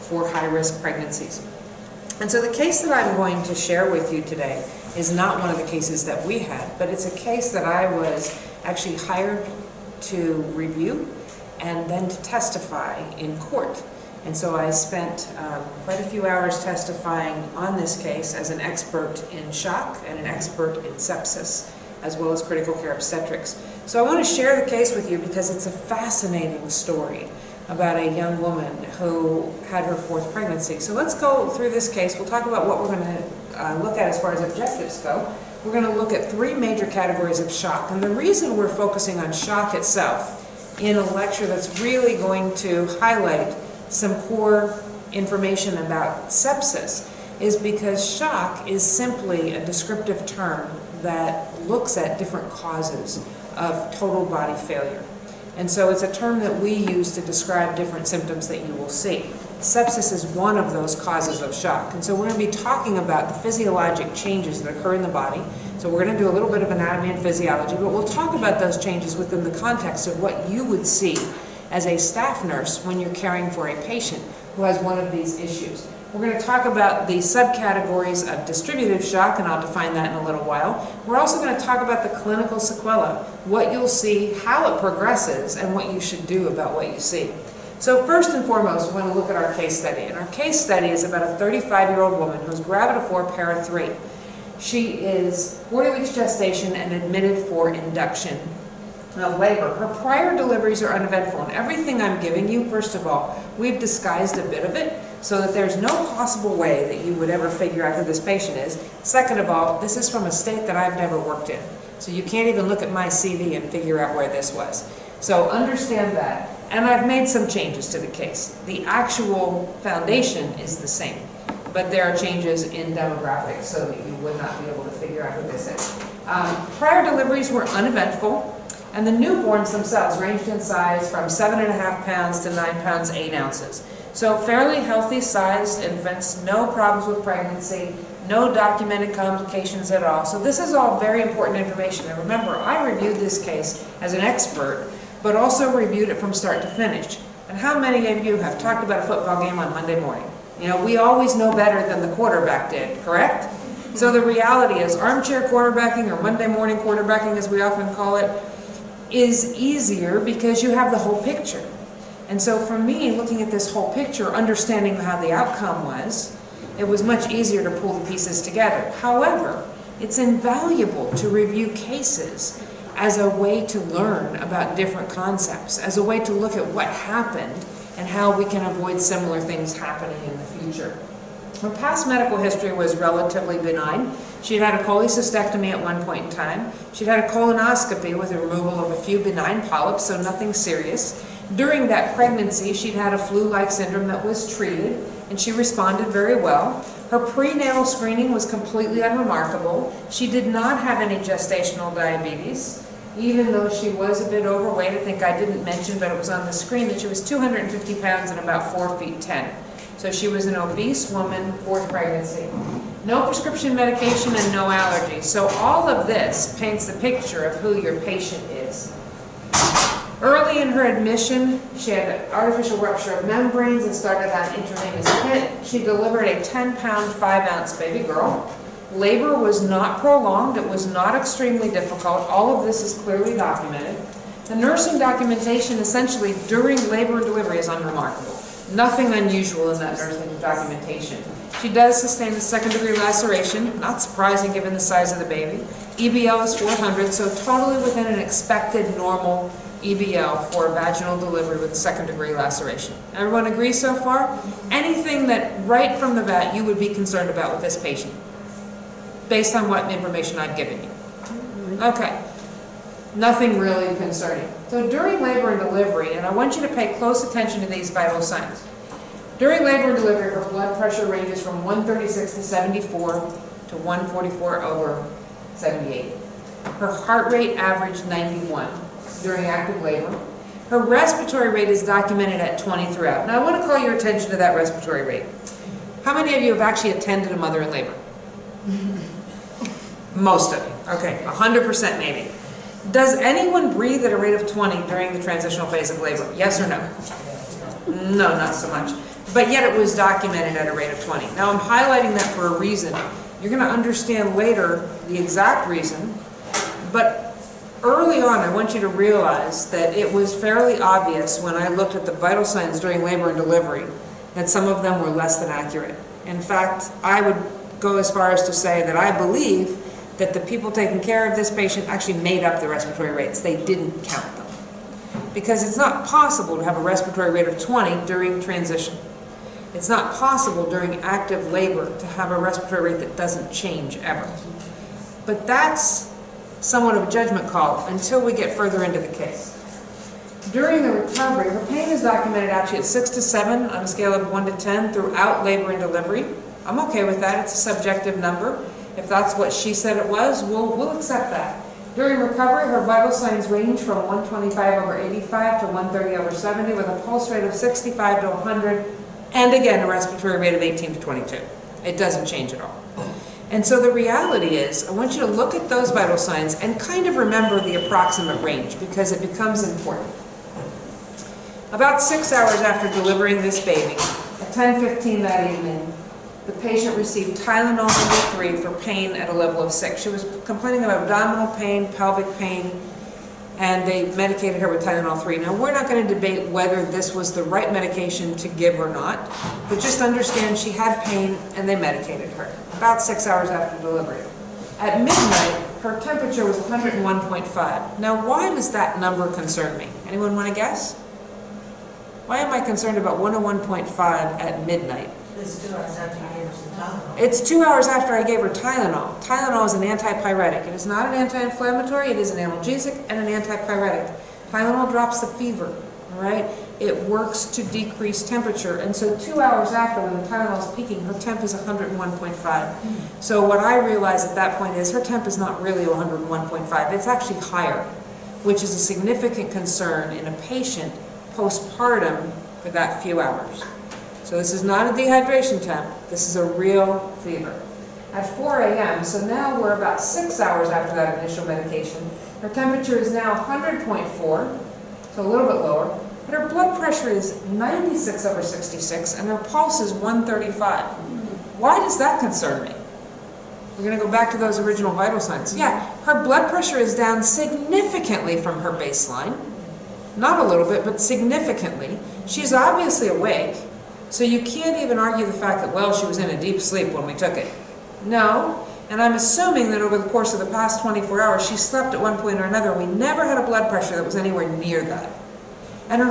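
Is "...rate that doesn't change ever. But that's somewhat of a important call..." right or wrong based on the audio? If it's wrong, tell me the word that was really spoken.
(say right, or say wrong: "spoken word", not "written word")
wrong: "judgment", not "important".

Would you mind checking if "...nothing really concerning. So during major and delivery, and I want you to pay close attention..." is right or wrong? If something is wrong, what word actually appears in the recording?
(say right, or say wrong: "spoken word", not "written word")
wrong: "labor", not "major".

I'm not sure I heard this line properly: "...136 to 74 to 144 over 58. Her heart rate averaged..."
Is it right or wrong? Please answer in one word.
wrong.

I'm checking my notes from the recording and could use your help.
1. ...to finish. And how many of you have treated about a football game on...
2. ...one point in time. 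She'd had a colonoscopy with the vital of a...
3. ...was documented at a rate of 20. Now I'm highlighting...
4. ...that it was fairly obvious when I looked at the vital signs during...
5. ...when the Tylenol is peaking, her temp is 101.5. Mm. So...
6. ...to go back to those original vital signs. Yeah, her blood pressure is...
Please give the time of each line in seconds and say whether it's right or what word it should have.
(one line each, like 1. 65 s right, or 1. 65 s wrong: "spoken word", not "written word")
1. 146 s wrong: "talked", not "treated"
2. 185 s wrong: "removal", not "vital"
3. 299 s right
4. 309 s right
5. 420 s right
6. 453 s right.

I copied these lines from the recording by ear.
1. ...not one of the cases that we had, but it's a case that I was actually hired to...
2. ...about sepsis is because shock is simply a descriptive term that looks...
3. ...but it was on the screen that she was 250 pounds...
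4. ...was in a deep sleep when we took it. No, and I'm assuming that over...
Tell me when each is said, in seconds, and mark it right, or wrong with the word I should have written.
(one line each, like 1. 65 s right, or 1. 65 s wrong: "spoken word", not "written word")
1. 5 s right
2. 45 s right
3. 205 s right
4. 466 s right.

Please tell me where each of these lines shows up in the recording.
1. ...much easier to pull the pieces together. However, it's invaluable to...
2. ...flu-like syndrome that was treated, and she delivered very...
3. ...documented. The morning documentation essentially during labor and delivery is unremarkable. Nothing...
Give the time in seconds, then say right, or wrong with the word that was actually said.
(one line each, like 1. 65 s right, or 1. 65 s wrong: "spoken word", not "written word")
1. 167 s right
2. 193 s wrong: "responded", not "delivered"
3. 233 s wrong: "nursing", not "morning".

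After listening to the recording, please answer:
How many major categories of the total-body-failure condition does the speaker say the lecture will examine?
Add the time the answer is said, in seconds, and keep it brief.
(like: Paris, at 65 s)
3, at 36 s.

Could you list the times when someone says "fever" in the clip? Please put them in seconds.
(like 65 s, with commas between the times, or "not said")
415 s, 437 s.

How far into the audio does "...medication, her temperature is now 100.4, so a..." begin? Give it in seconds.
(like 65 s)
441 s.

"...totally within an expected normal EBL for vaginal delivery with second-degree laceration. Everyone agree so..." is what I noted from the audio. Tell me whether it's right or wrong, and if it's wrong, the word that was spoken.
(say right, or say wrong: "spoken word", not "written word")
right.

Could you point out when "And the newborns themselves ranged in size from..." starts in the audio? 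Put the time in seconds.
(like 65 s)
128 s.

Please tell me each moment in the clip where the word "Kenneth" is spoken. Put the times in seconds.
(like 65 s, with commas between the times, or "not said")
not said.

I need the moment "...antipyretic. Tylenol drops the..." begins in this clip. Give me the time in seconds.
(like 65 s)
413 s.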